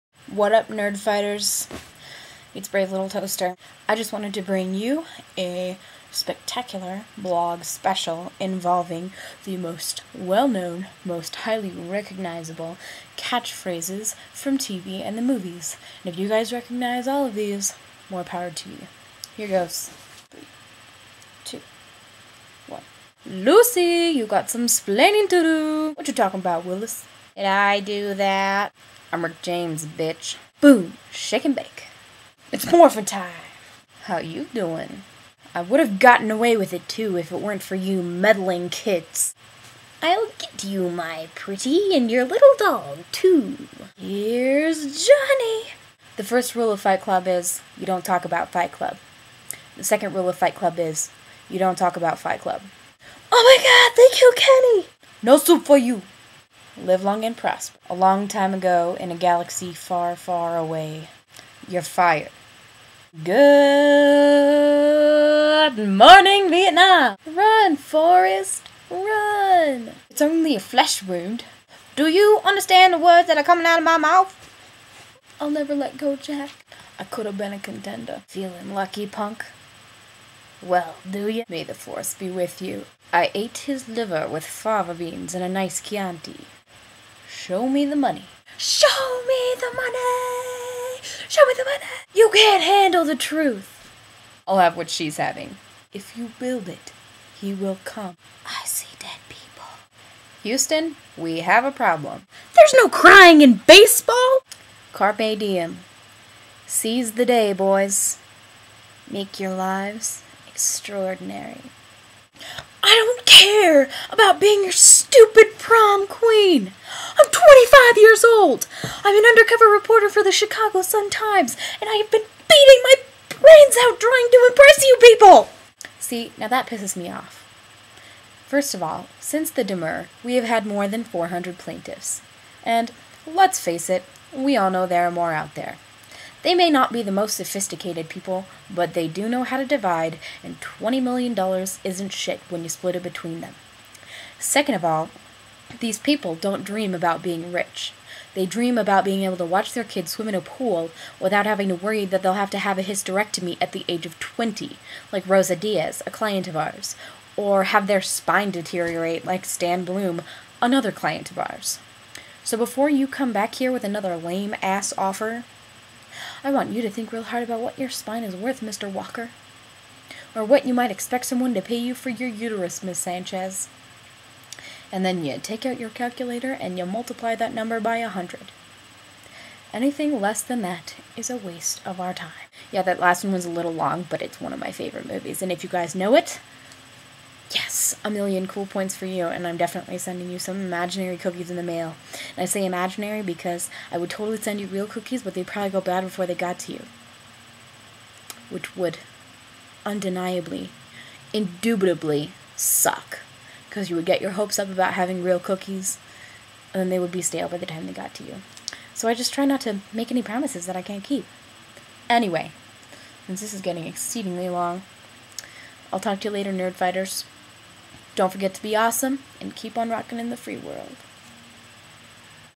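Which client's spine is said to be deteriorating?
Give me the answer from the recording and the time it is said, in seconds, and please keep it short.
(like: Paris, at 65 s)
Stan Bloom, at 159 s.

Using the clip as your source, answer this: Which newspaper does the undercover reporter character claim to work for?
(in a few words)
Chicago Sun-Times.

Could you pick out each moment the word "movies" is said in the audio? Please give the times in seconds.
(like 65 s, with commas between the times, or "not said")
15 s, 185 s.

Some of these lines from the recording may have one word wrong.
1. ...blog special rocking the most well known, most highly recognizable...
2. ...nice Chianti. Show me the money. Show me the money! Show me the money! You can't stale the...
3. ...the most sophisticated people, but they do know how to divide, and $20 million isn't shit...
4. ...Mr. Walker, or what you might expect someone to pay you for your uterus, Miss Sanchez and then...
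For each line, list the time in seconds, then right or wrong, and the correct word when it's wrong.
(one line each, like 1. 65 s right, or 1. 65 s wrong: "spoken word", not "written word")
1. 7 s wrong: "involving", not "rocking"
2. 85 s wrong: "handle", not "stale"
3. 137 s right
4. 168 s right.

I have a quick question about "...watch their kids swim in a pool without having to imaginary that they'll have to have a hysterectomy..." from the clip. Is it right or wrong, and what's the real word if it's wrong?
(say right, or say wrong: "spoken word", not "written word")
wrong: "worry", not "imaginary".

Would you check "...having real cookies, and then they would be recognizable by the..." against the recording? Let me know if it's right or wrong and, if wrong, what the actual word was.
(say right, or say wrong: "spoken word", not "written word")
wrong: "stale", not "recognizable".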